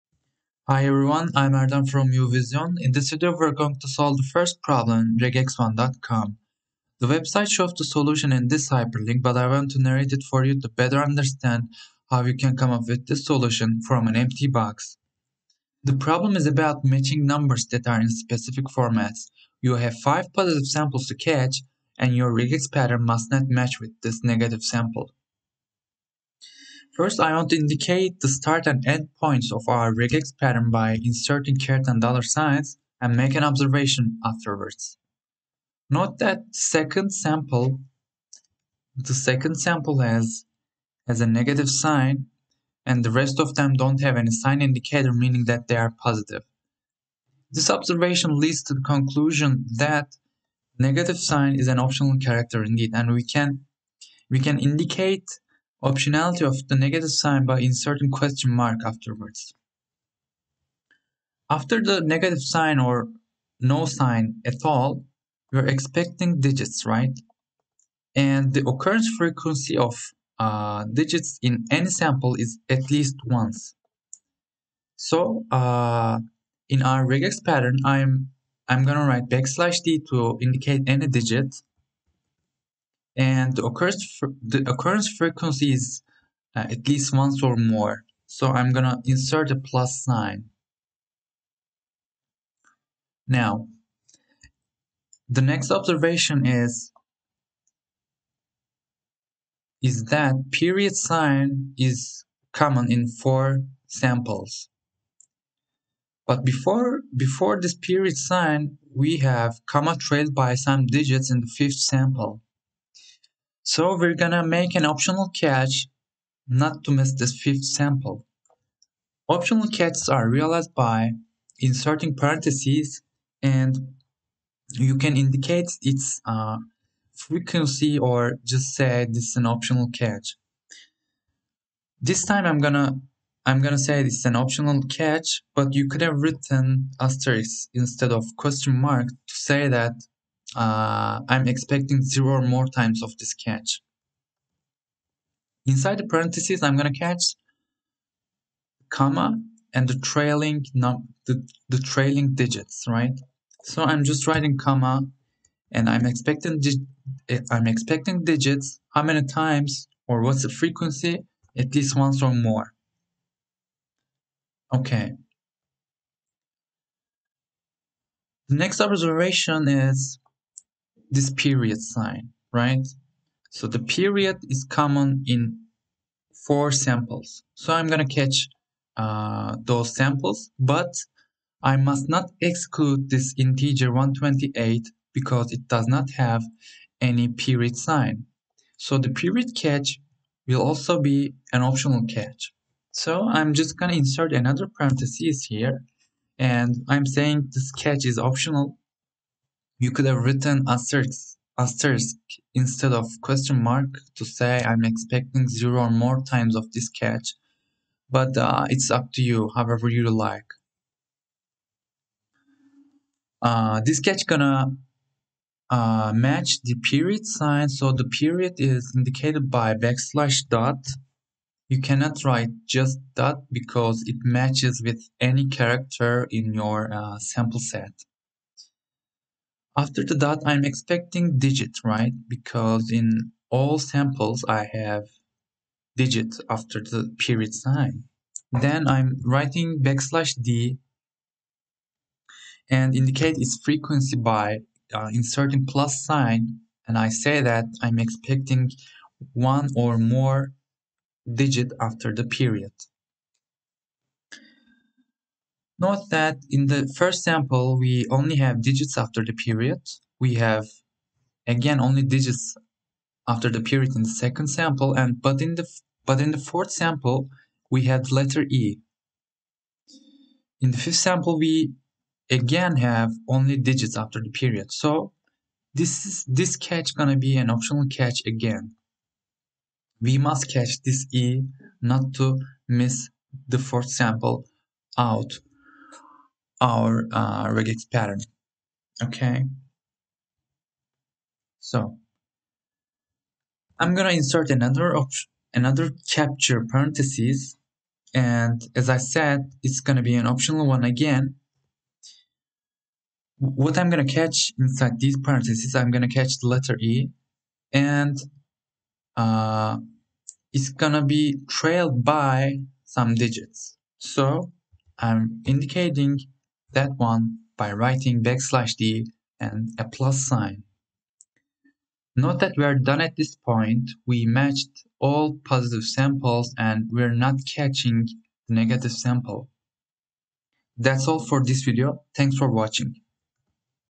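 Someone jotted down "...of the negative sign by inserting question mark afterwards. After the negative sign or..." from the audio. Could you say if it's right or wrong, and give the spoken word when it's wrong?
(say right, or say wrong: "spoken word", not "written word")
right.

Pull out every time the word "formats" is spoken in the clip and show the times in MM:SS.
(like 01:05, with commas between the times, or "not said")
00:18.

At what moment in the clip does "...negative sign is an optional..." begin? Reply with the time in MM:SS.
00:50.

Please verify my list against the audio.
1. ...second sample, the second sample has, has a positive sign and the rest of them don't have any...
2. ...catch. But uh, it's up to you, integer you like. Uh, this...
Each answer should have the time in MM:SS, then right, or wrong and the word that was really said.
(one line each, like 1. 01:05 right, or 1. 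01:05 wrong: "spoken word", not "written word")
1. 00:36 wrong: "negative", not "positive"
2. 03:26 wrong: "however", not "integer".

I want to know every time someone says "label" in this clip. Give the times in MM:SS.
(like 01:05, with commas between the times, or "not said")
not said.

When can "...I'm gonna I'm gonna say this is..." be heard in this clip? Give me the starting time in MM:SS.
02:12.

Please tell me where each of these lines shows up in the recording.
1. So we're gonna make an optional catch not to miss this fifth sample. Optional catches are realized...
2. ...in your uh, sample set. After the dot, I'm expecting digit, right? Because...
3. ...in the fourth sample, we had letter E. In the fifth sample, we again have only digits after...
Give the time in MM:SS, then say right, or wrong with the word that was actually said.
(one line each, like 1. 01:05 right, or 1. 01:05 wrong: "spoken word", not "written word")
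1. 01:53 right
2. 03:46 right
3. 04:26 right.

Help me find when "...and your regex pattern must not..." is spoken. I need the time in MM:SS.
00:21.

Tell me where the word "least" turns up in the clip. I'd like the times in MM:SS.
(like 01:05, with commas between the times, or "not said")
01:12, 01:26, 02:41.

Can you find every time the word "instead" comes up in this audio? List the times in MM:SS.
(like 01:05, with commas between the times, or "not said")
02:17, 03:22.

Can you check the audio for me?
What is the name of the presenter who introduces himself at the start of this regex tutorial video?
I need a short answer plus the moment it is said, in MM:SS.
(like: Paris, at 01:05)
Erdem, at 00:01.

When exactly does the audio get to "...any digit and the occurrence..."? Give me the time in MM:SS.
01:20.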